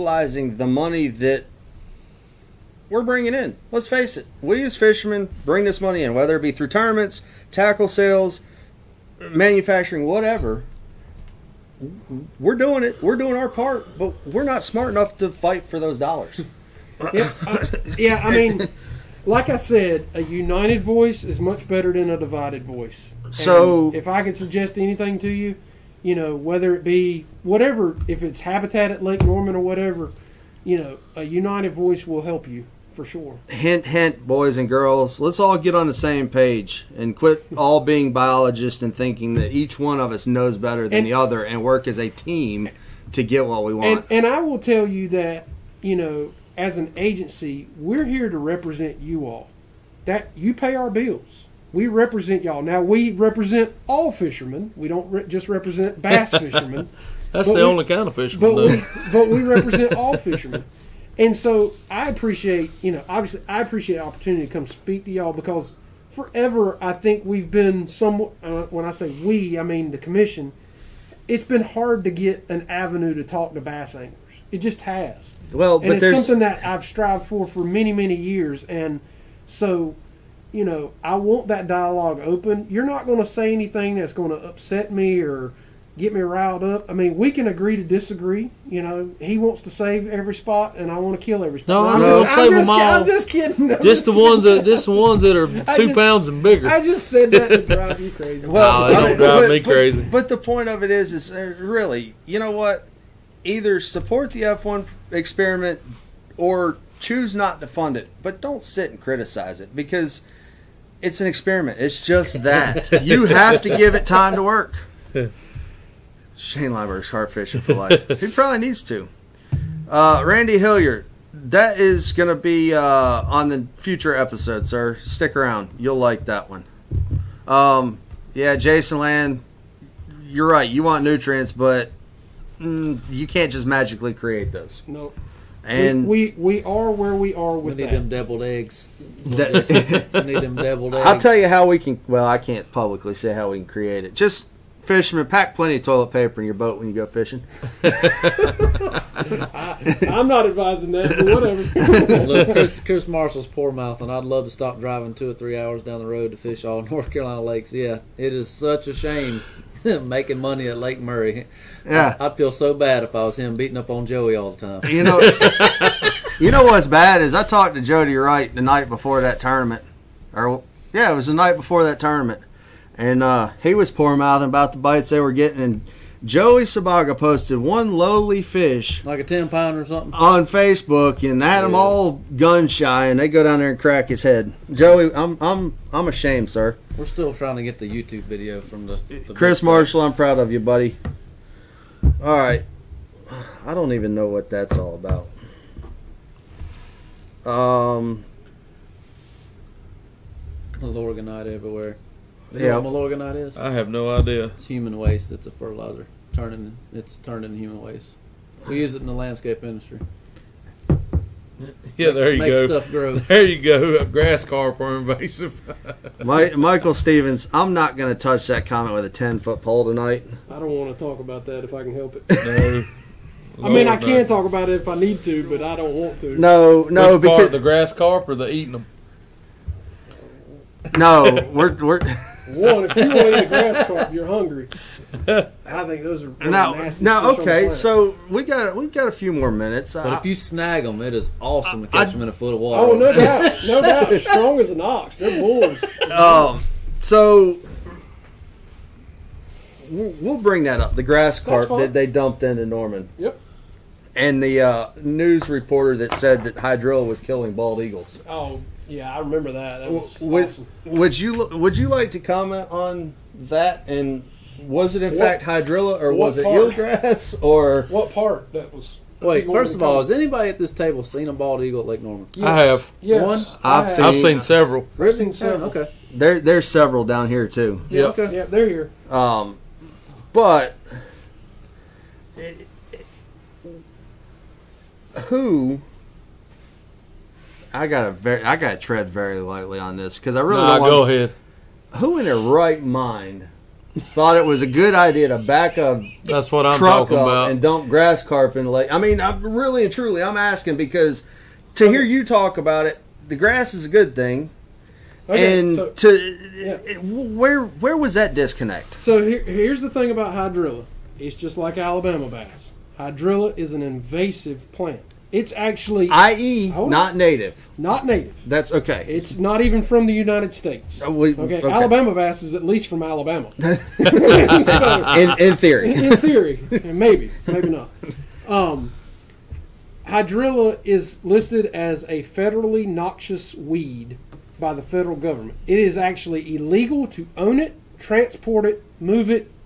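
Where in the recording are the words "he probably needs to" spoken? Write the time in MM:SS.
01:58.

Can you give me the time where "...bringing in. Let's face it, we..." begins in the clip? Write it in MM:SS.
00:03.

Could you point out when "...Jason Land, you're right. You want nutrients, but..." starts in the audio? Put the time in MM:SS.
02:08.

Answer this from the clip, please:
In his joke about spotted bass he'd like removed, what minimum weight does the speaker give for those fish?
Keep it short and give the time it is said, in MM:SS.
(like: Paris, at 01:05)
2 pounds, at 01:35.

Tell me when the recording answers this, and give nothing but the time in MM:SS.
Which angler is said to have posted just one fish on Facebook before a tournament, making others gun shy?
02:56.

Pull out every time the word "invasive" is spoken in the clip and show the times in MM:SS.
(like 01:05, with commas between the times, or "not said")
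03:34, 05:13.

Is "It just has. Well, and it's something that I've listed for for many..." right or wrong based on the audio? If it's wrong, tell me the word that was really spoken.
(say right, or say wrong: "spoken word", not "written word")
wrong: "strived", not "listed".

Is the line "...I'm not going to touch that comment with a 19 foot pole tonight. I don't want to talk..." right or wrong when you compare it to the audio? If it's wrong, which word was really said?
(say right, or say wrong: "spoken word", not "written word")
wrong: "10", not "19".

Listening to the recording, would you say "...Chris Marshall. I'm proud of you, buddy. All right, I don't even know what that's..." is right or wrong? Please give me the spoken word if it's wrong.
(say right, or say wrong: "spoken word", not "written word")
right.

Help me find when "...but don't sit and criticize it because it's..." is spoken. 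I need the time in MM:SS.
01:48.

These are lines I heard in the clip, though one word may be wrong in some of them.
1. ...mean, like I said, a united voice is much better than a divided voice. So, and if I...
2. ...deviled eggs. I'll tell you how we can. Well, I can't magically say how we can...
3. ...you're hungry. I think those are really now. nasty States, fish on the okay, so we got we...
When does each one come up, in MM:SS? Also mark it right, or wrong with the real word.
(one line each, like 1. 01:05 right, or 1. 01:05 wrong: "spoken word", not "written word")
1. 00:18 right
2. 02:20 wrong: "publicly", not "magically"
3. 03:54 wrong: "Now", not "States".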